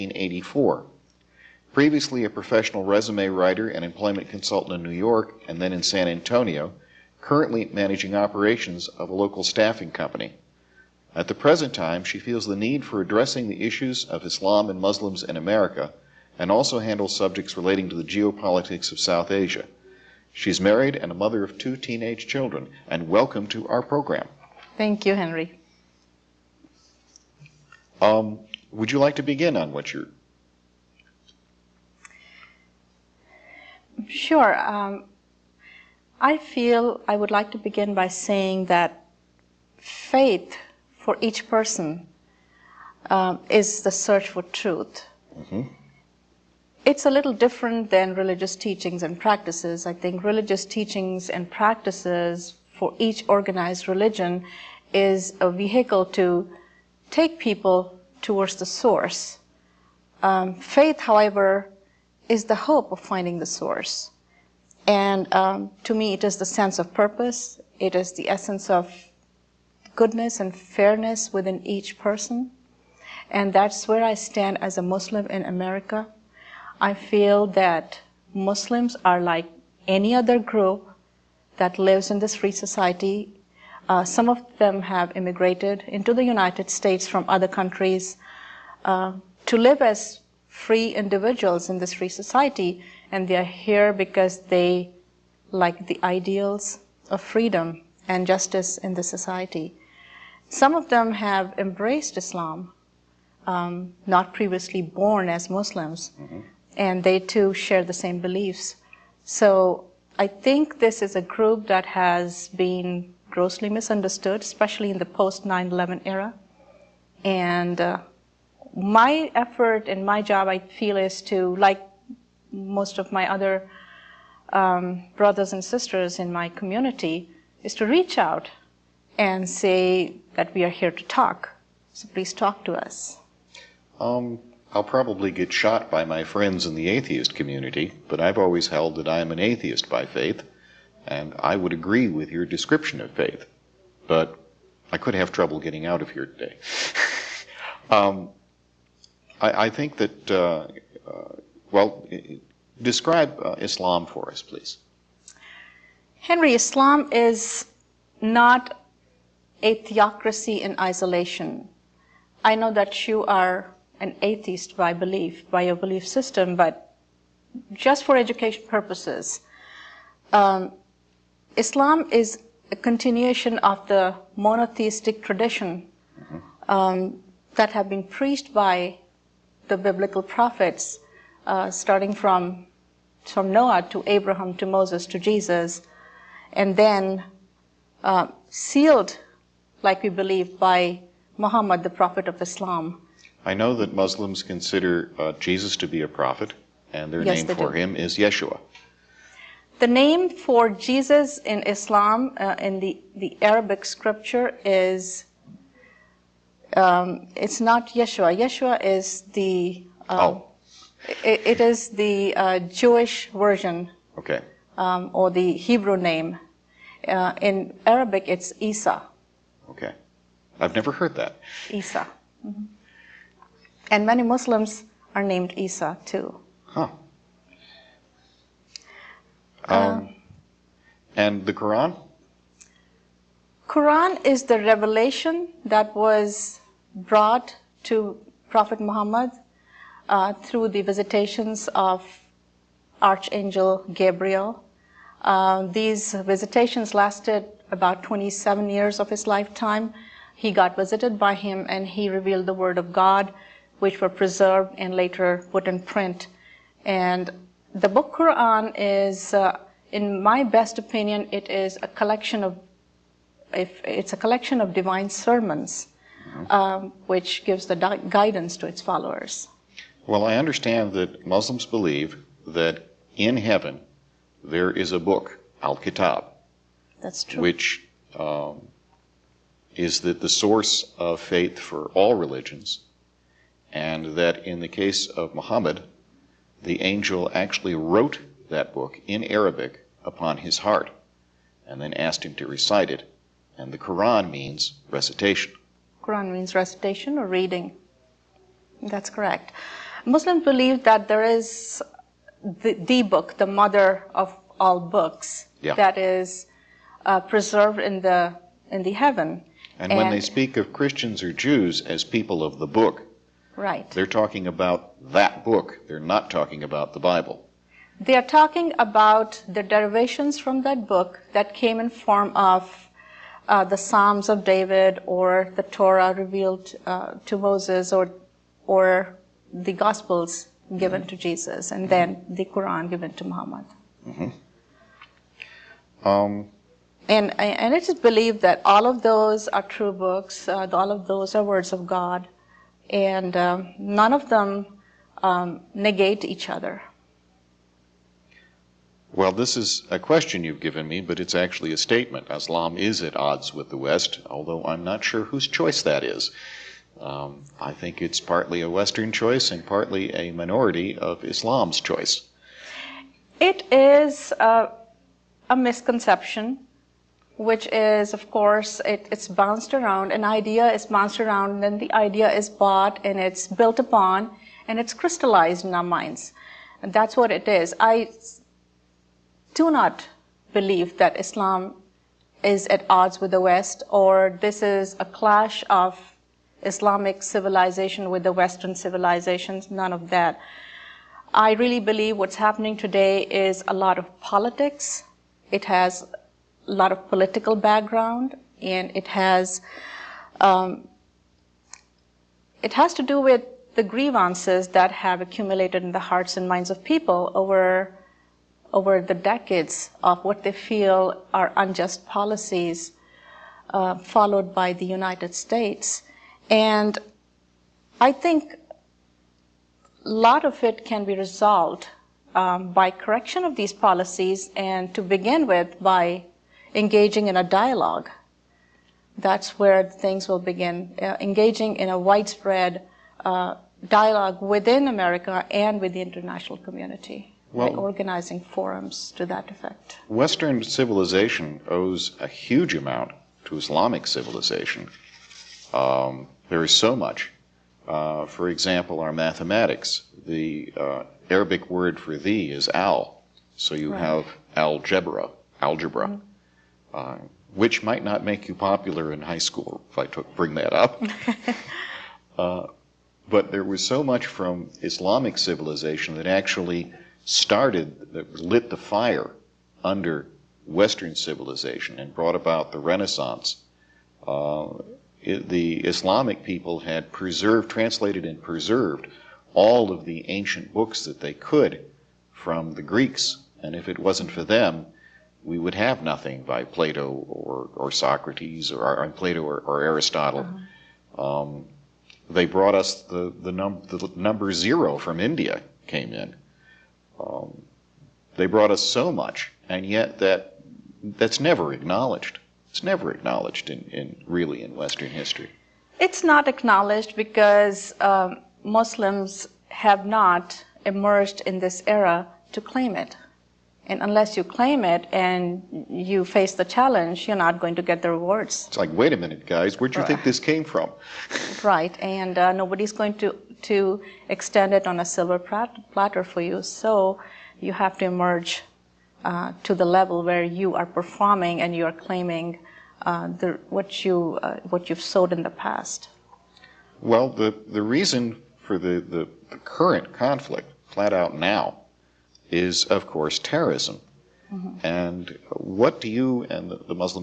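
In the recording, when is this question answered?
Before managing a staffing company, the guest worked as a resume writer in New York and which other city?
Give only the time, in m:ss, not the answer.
0:05.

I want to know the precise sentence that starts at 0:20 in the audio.
She's married and a mother of two teenage children, and welcome to our program.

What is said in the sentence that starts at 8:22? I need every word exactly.
It's never acknowledged in, in really in Western history.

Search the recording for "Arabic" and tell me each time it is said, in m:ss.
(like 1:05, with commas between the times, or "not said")
3:23, 3:37, 4:49, 7:31.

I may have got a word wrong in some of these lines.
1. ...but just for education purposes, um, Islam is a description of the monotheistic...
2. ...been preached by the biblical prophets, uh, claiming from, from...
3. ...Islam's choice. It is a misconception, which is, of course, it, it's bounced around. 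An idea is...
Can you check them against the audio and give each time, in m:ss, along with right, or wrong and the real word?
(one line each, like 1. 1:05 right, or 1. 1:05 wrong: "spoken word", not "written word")
1. 2:46 wrong: "continuation", not "description"
2. 2:57 wrong: "starting", not "claiming"
3. 6:01 right.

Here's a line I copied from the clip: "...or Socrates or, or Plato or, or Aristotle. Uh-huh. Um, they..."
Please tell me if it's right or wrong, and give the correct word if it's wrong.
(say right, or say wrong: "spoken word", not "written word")
right.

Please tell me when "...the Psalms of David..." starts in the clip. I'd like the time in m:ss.
5:23.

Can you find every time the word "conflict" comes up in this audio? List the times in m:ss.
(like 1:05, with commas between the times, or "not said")
9:00.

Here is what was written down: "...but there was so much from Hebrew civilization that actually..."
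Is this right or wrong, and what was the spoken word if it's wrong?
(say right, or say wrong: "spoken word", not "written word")
wrong: "Islamic", not "Hebrew".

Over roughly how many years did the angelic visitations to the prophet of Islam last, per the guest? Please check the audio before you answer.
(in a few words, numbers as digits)
27.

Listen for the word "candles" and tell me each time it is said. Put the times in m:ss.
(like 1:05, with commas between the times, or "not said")
not said.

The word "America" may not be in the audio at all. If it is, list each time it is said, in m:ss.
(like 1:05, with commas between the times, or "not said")
0:15, 1:15, 7:14.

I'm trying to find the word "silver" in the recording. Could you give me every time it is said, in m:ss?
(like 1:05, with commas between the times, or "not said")
8:45.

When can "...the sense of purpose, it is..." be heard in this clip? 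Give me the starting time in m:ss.
1:06.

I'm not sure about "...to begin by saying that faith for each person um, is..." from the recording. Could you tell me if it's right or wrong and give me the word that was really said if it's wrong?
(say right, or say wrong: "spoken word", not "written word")
right.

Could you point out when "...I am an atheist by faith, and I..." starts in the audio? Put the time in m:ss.
2:19.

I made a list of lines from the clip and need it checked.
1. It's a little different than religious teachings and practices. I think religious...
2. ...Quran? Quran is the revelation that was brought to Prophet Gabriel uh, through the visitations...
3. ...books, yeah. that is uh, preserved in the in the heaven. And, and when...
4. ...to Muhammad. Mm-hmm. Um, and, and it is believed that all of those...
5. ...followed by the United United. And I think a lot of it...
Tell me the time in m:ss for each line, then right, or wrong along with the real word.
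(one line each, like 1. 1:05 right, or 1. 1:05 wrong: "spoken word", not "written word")
1. 0:46 right
2. 3:51 wrong: "Muhammad", not "Gabriel"
3. 5:04 right
4. 5:33 right
5. 6:53 wrong: "States", not "United".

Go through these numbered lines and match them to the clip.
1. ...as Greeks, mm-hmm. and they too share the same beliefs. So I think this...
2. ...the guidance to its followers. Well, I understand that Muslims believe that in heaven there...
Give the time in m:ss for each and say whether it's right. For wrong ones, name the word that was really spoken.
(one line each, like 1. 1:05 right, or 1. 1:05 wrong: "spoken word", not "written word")
1. 1:45 wrong: "Muslims", not "Greeks"
2. 4:27 right.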